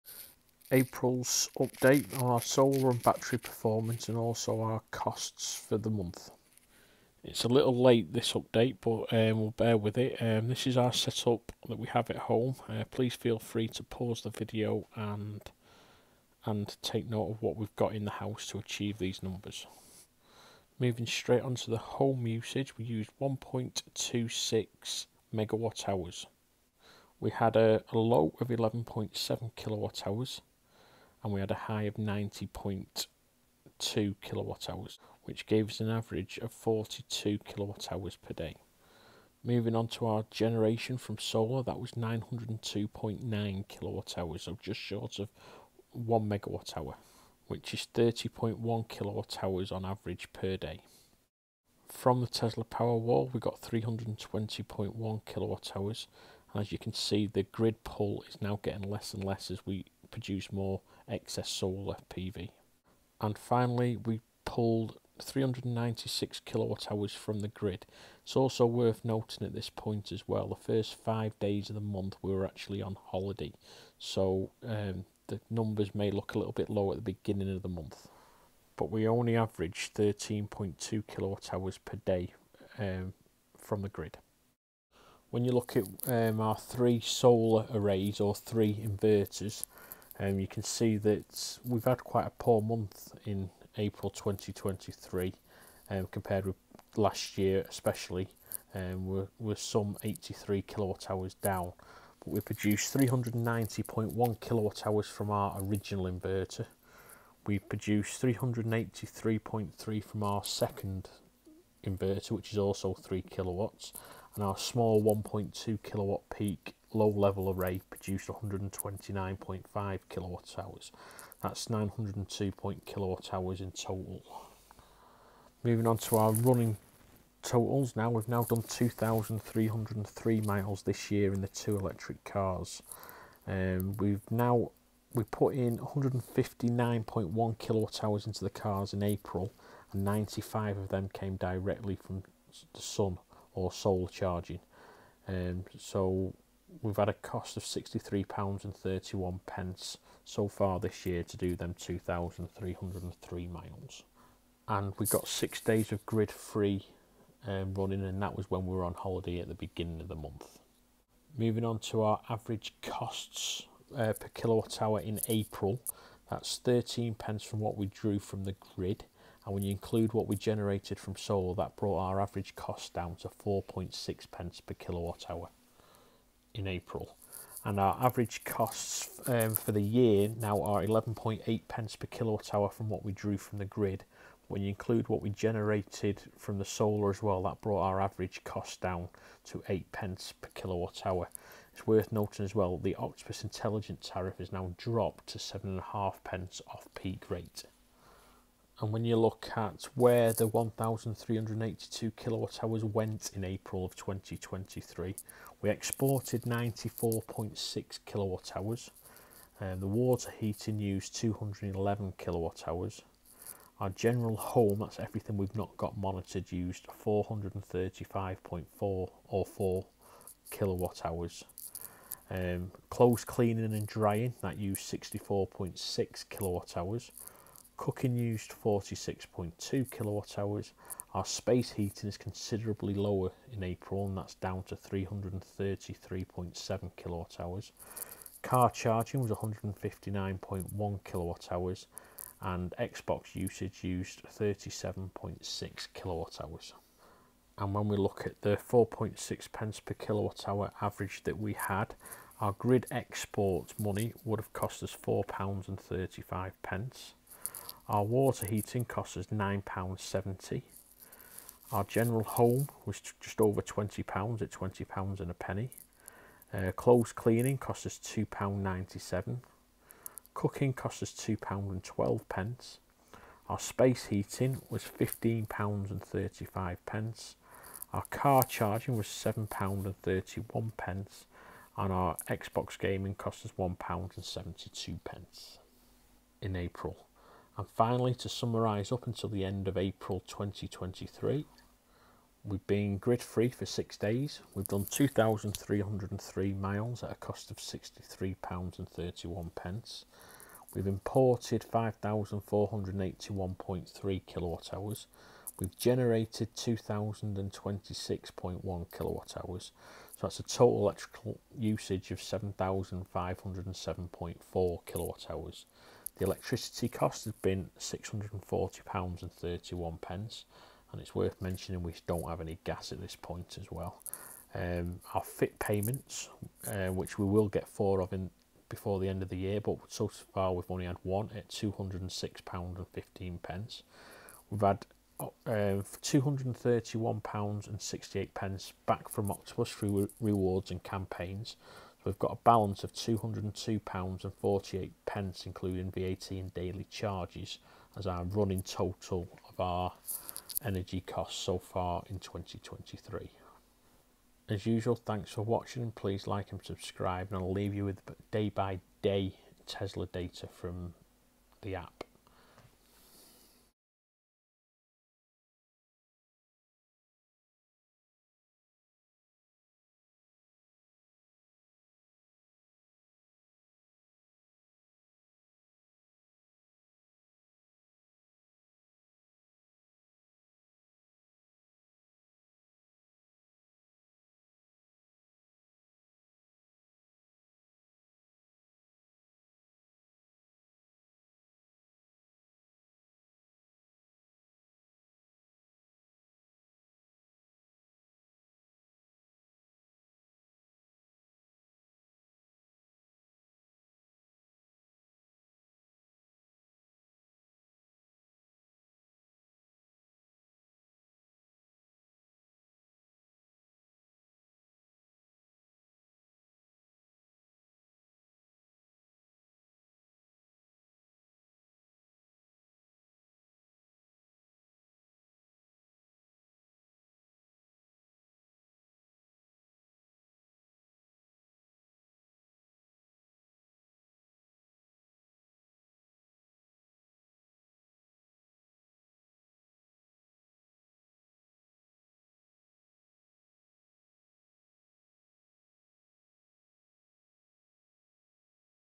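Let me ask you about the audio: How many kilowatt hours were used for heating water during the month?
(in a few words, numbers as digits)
211.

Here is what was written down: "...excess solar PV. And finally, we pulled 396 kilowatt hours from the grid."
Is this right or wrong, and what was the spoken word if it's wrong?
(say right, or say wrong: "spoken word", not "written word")
right.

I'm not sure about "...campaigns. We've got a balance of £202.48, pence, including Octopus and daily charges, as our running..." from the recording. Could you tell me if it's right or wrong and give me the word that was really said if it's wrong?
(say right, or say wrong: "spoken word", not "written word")
wrong: "VAT", not "Octopus".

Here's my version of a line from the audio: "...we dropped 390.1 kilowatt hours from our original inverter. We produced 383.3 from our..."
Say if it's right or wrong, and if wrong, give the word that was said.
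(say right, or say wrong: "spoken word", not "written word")
wrong: "produced", not "dropped".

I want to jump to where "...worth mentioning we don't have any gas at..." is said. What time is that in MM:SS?
05:21.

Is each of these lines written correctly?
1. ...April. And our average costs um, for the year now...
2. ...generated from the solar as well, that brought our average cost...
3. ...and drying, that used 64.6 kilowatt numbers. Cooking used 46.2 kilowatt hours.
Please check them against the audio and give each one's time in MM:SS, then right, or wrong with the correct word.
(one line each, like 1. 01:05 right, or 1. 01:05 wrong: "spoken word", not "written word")
1. 02:56 right
2. 03:05 right
3. 03:43 wrong: "hours", not "numbers".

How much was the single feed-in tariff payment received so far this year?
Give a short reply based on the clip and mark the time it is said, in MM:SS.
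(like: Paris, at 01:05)
£206.15, at 05:31.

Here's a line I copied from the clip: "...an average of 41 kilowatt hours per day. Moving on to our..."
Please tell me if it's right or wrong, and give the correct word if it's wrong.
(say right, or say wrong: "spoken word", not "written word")
wrong: "42", not "41".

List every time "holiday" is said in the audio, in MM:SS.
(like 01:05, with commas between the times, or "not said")
01:13, 02:38.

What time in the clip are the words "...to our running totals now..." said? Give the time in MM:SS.
02:05.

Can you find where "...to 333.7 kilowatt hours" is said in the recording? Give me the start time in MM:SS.
03:54.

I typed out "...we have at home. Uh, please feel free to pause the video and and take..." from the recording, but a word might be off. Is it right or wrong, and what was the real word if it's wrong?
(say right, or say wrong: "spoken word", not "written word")
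right.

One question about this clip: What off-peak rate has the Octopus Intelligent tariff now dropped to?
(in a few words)
7.5 pence.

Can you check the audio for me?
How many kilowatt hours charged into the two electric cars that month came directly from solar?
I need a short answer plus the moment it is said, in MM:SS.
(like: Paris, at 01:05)
95, at 02:20.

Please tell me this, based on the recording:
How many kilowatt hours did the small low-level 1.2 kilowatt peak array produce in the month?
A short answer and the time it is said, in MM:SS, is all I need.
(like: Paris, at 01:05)
129.5, at 01:58.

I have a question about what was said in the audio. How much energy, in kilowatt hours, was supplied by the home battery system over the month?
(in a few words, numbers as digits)
320.1.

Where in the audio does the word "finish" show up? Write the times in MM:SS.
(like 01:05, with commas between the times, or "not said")
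not said.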